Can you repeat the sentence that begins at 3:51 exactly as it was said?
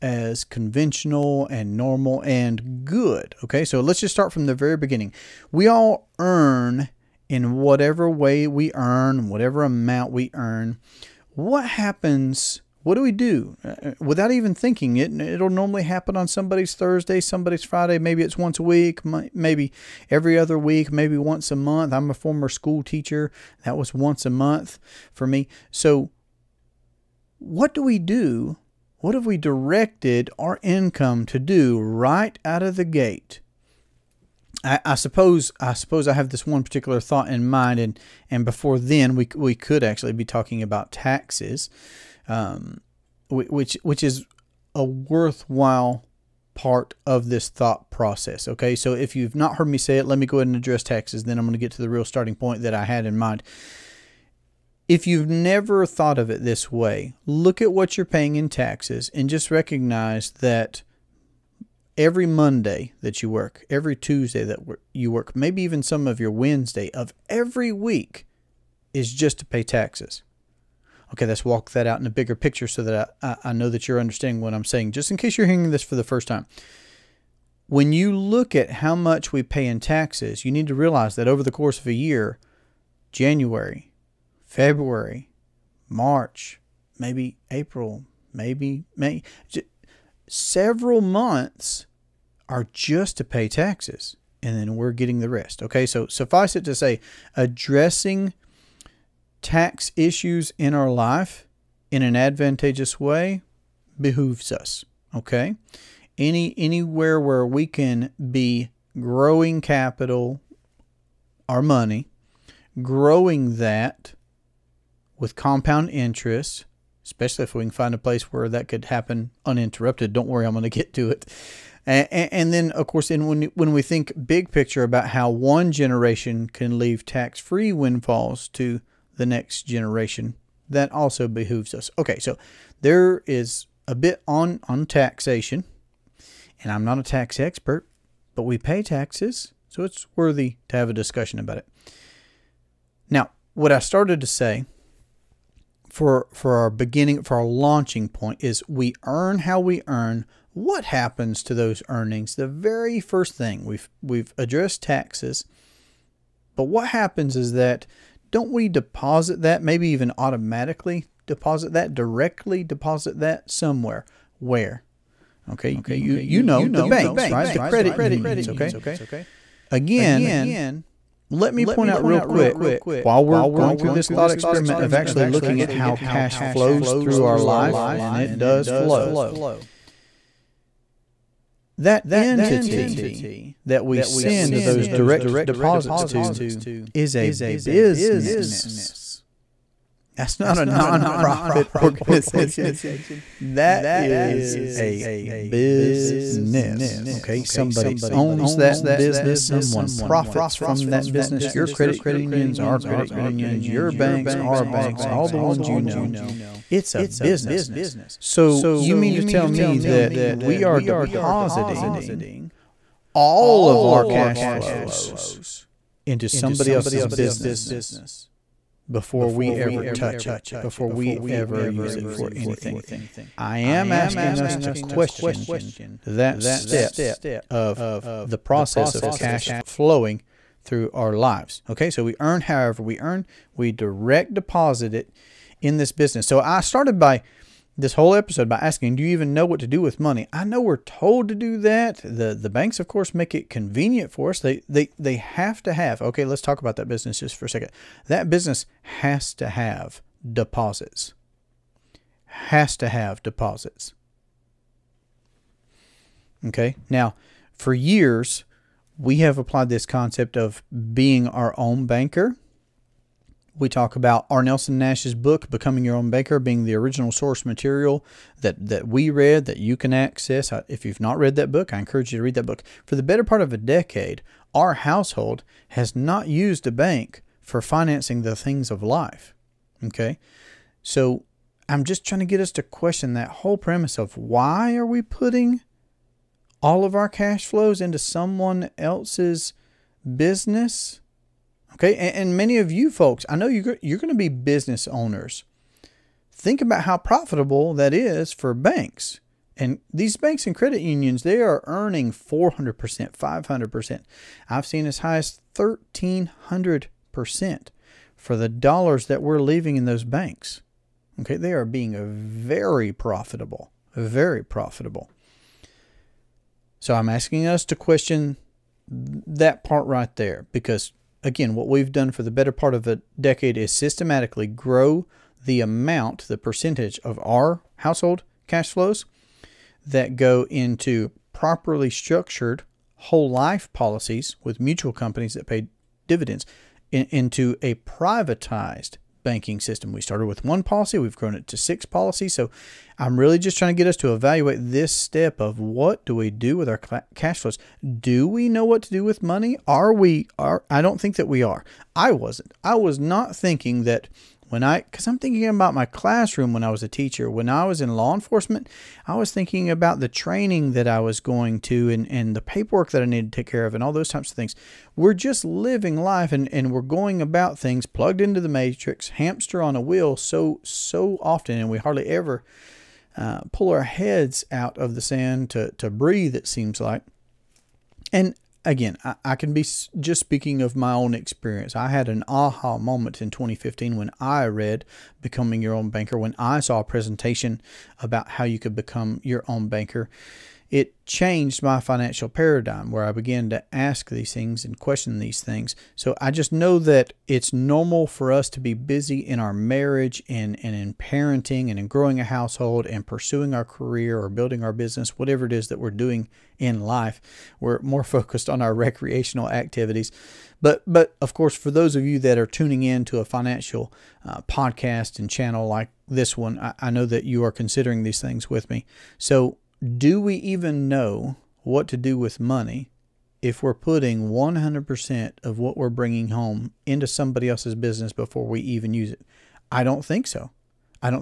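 Okay, so we earn however we earn, we direct deposit it in this business.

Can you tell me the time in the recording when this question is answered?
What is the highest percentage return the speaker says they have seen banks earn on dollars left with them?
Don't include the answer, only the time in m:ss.
5:05.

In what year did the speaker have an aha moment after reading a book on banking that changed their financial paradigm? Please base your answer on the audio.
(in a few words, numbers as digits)
2015.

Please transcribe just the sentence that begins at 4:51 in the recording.
Okay, and, and many of you folks, I know you're, you're going to be business owners.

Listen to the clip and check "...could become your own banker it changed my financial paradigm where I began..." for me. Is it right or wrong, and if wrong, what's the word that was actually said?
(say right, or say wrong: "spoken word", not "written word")
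right.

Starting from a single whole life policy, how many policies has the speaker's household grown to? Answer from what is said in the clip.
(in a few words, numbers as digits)
6.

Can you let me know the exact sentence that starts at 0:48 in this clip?
Okay, so if you've not heard me say it, let me go ahead and address taxes.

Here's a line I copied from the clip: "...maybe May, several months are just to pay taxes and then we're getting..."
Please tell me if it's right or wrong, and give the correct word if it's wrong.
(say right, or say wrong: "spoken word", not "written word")
right.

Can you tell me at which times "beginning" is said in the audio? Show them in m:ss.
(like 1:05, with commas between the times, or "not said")
0:04, 2:26.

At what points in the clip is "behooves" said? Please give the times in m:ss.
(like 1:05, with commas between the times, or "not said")
1:43, 2:11.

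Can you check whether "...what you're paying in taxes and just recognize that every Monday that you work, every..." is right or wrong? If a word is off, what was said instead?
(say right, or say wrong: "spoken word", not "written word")
right.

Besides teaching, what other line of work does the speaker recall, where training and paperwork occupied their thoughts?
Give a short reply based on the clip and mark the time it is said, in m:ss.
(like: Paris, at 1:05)
law enforcement, at 5:57.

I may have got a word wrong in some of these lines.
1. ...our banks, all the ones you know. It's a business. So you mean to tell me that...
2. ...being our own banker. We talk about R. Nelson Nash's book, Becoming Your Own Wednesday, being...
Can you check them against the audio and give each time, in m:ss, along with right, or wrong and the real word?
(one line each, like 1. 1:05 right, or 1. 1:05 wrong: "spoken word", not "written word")
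1. 3:24 right
2. 4:20 wrong: "Banker", not "Wednesday".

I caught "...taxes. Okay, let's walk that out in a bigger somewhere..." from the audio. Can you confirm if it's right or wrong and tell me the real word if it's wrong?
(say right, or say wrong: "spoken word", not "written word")
wrong: "picture", not "somewhere".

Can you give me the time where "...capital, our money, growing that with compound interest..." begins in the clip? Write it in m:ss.
1:49.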